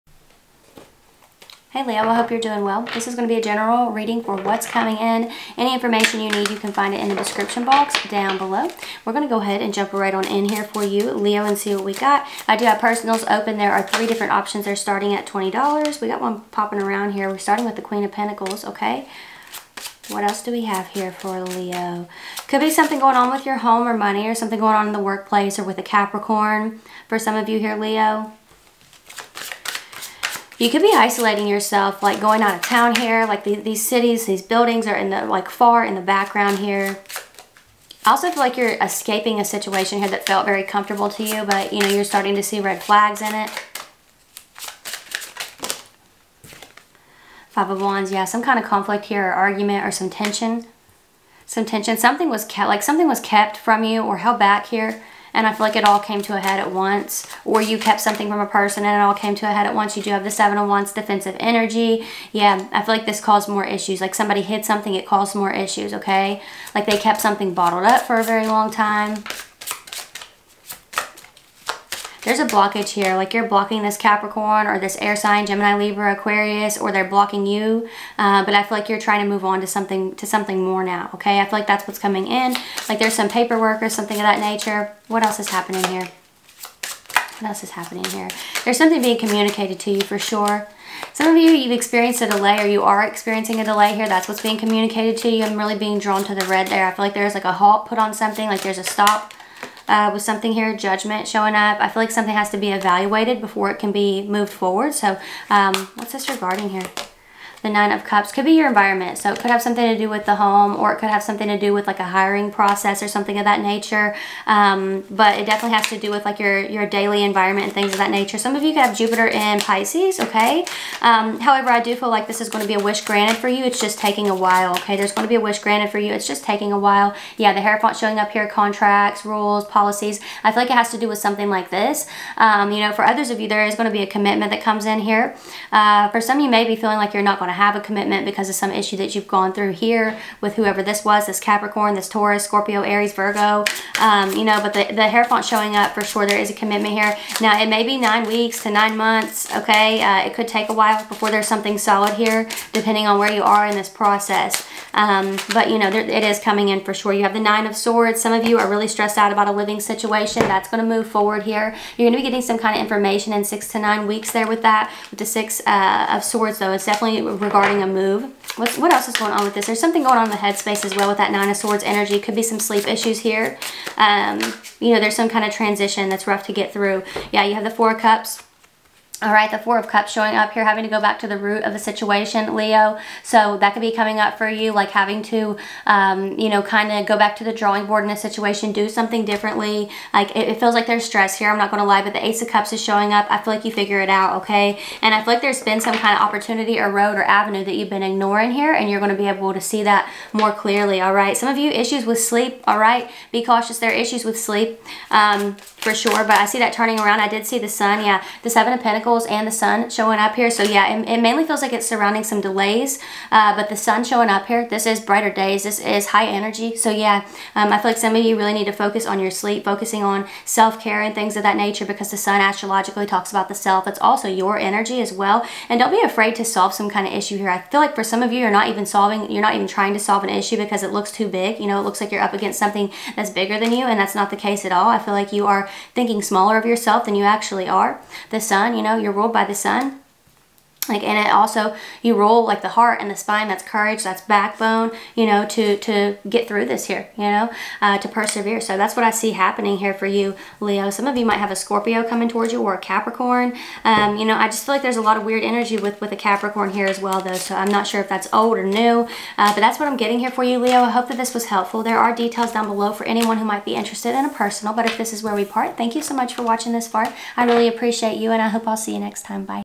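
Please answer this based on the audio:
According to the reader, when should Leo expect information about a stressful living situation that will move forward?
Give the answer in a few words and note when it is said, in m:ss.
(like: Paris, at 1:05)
6 to 9 weeks, at 2:43.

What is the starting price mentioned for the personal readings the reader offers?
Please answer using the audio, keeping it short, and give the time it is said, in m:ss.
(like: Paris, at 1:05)
$20, at 0:15.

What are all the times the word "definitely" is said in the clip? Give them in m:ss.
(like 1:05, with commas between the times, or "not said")
1:55, 2:46.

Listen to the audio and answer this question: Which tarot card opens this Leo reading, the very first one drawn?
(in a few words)
Queen of Pentacles.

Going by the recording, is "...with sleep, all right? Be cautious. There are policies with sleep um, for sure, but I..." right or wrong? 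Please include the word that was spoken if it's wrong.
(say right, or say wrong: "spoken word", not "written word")
wrong: "issues", not "policies".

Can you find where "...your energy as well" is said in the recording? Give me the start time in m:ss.
3:44.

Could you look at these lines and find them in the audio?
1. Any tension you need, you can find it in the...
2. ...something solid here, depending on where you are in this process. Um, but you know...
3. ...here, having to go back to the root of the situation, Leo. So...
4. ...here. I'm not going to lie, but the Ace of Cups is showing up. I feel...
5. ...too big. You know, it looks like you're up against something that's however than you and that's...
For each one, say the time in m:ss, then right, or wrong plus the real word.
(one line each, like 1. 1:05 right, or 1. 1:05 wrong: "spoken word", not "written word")
1. 0:05 wrong: "information", not "tension"
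2. 2:31 right
3. 3:00 right
4. 3:11 right
5. 3:51 wrong: "bigger", not "however".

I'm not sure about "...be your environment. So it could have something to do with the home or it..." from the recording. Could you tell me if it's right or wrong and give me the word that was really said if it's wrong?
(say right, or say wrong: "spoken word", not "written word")
right.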